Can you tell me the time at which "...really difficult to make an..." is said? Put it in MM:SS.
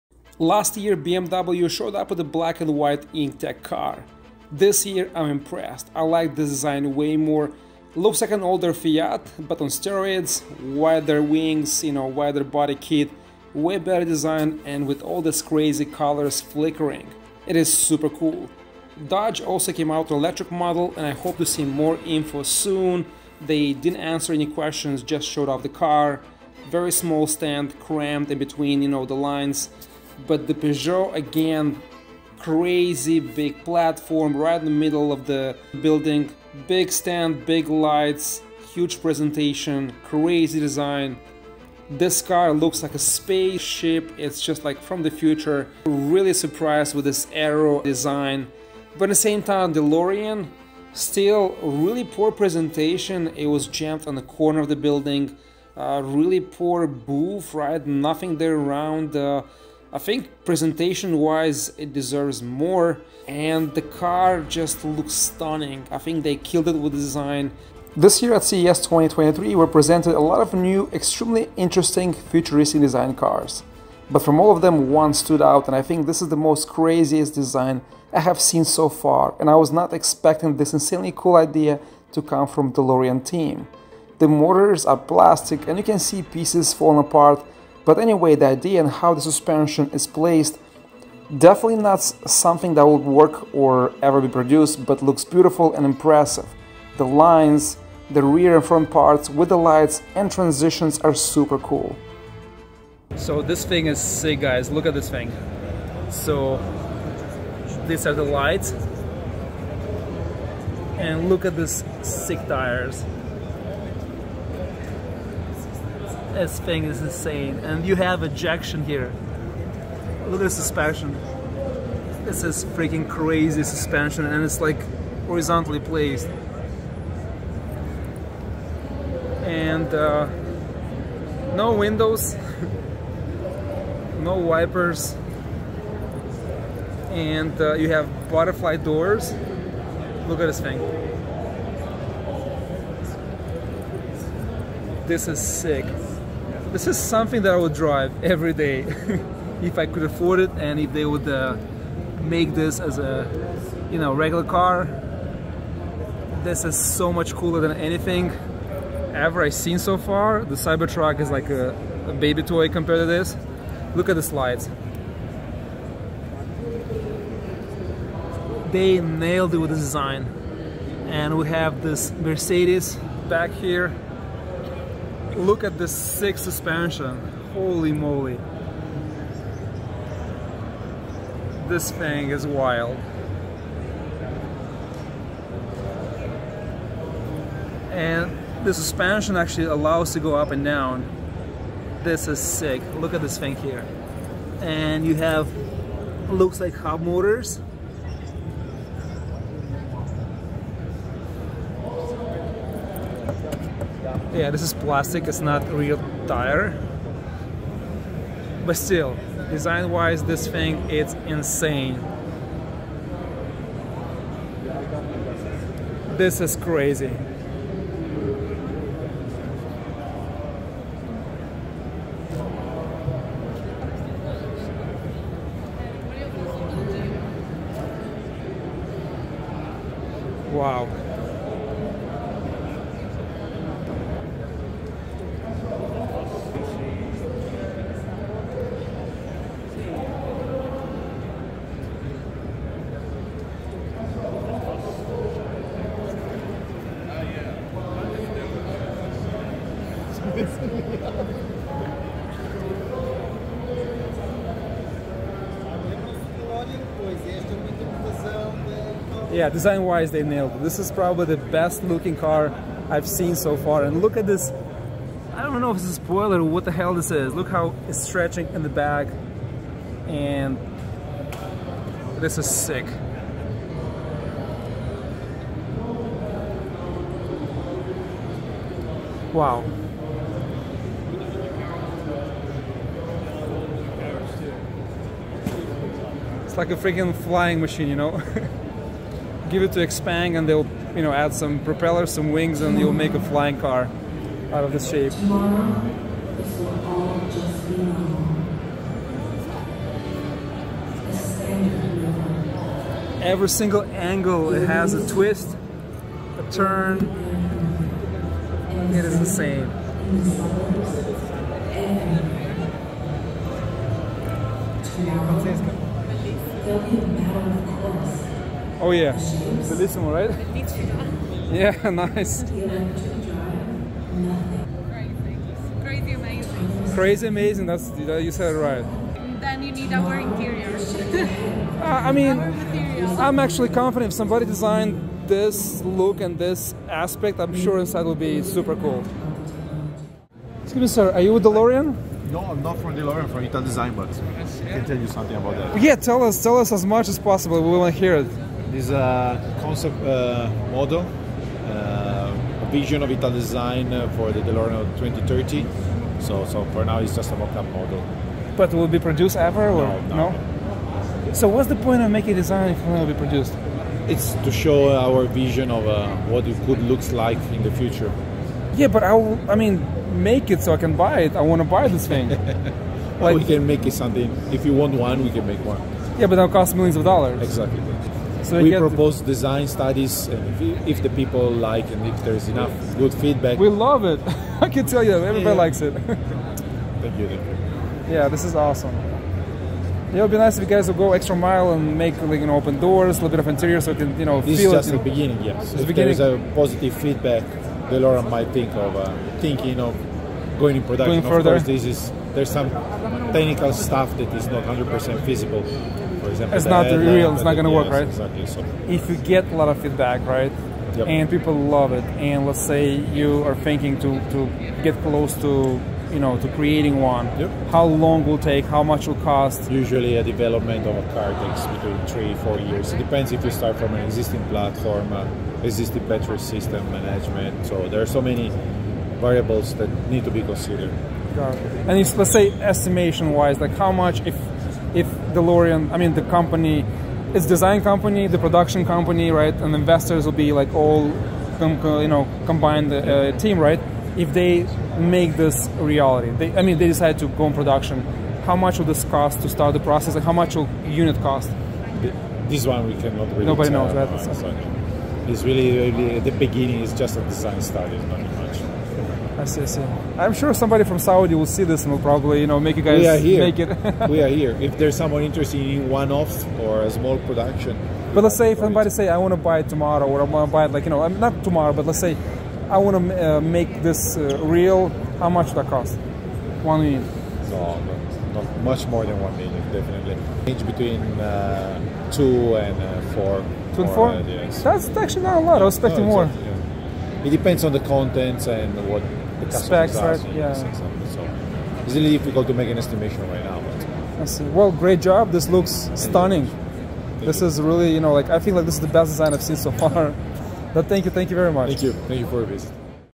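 08:11.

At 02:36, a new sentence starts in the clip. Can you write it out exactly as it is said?
This is so much cooler than anything ever I've seen so far.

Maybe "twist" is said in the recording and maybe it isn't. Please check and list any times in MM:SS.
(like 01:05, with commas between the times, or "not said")
05:05.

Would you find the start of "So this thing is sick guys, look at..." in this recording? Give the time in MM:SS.
01:43.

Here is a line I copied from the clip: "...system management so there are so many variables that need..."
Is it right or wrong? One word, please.
right.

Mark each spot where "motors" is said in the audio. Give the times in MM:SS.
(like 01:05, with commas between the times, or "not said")
01:24, 03:17.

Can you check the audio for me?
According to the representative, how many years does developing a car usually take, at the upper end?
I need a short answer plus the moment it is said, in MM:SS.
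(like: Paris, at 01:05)
4 years, at 07:02.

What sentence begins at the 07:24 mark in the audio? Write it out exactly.
If they make this reality, they, I mean, they decide to go in production.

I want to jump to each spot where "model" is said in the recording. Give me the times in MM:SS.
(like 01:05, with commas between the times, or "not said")
00:20, 05:50, 05:57.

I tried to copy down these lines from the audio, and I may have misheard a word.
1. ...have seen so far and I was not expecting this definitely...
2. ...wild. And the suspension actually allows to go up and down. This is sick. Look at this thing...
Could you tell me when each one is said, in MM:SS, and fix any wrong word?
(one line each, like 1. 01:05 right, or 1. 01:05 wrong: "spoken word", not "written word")
1. 01:18 wrong: "insanely", not "definitely"
2. 03:02 right.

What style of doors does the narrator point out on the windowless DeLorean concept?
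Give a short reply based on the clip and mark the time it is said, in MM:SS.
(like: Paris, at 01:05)
Butterfly doors, at 02:18.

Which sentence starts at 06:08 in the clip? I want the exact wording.
Yeah, but I, I mean, make it so I can buy it.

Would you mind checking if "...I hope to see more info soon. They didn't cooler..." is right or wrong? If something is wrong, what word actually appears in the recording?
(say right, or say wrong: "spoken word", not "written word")
wrong: "answer", not "cooler".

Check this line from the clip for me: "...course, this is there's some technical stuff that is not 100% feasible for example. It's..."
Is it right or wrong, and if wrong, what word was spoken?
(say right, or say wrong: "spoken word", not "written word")
right.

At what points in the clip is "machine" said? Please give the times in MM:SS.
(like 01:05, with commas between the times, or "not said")
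04:47.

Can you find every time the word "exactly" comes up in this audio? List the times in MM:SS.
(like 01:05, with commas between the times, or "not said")
06:17, 06:48, 08:06.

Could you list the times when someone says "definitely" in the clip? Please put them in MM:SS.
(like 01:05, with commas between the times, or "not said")
01:31, 07:59.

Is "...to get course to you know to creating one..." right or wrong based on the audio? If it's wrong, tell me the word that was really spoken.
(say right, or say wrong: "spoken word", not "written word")
wrong: "close", not "course".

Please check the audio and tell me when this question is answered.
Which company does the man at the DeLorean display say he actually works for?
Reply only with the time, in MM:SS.
05:43.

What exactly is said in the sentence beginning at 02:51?
And we have this Mercedes back here Look at the sick suspension.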